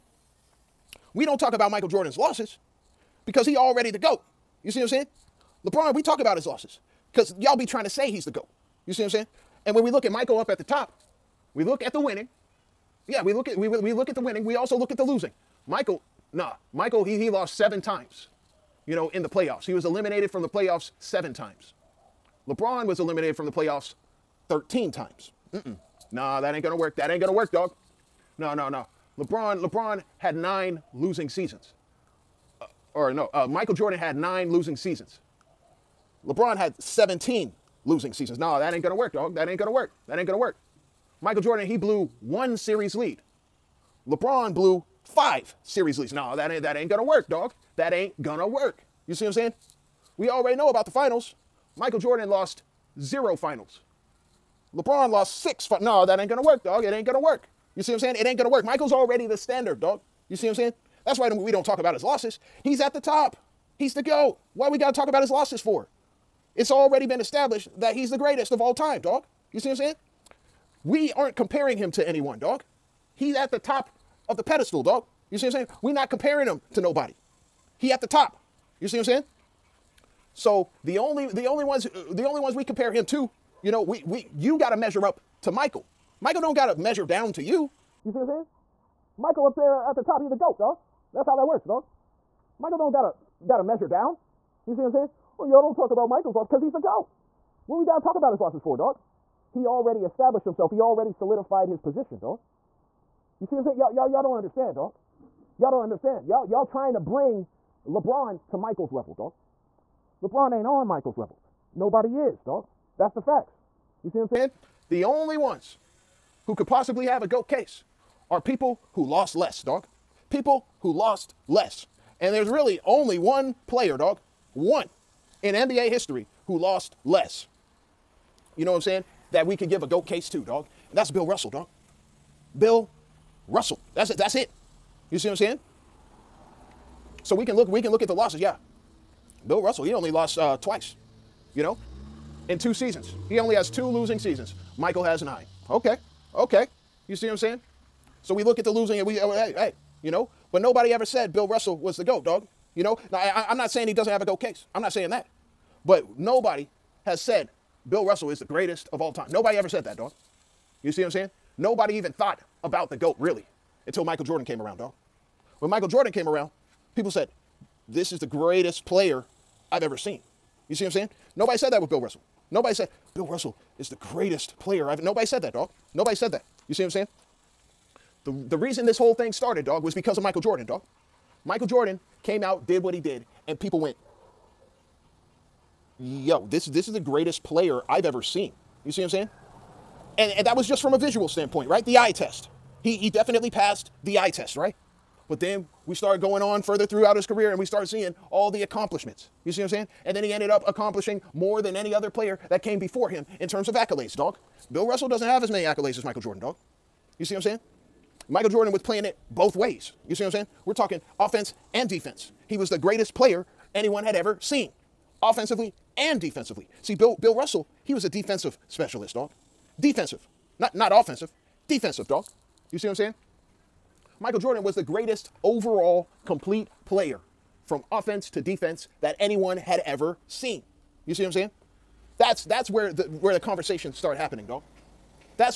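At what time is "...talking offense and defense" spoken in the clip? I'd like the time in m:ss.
3:30.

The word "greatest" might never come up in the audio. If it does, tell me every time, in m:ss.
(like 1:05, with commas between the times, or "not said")
1:08, 2:38, 2:48, 2:53, 3:06, 3:32, 3:44.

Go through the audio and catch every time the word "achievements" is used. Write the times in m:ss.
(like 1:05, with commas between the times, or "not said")
not said.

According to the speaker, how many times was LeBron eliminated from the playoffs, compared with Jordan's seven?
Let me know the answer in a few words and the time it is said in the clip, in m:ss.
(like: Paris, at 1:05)
13, at 0:24.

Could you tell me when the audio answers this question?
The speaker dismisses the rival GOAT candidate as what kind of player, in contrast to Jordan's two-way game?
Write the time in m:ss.
3:38.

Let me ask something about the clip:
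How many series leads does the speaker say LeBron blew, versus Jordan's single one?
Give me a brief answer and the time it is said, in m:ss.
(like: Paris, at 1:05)
5, at 0:45.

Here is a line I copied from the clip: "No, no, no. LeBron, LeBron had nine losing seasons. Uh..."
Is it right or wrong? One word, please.
right.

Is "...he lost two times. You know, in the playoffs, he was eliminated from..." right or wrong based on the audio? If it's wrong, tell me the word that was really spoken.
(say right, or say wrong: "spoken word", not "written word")
wrong: "seven", not "two".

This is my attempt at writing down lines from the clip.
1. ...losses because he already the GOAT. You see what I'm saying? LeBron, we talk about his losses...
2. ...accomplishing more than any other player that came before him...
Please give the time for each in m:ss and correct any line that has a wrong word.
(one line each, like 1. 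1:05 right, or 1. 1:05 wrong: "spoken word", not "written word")
1. 0:02 right
2. 3:20 right.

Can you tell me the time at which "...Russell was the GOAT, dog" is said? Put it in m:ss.
2:31.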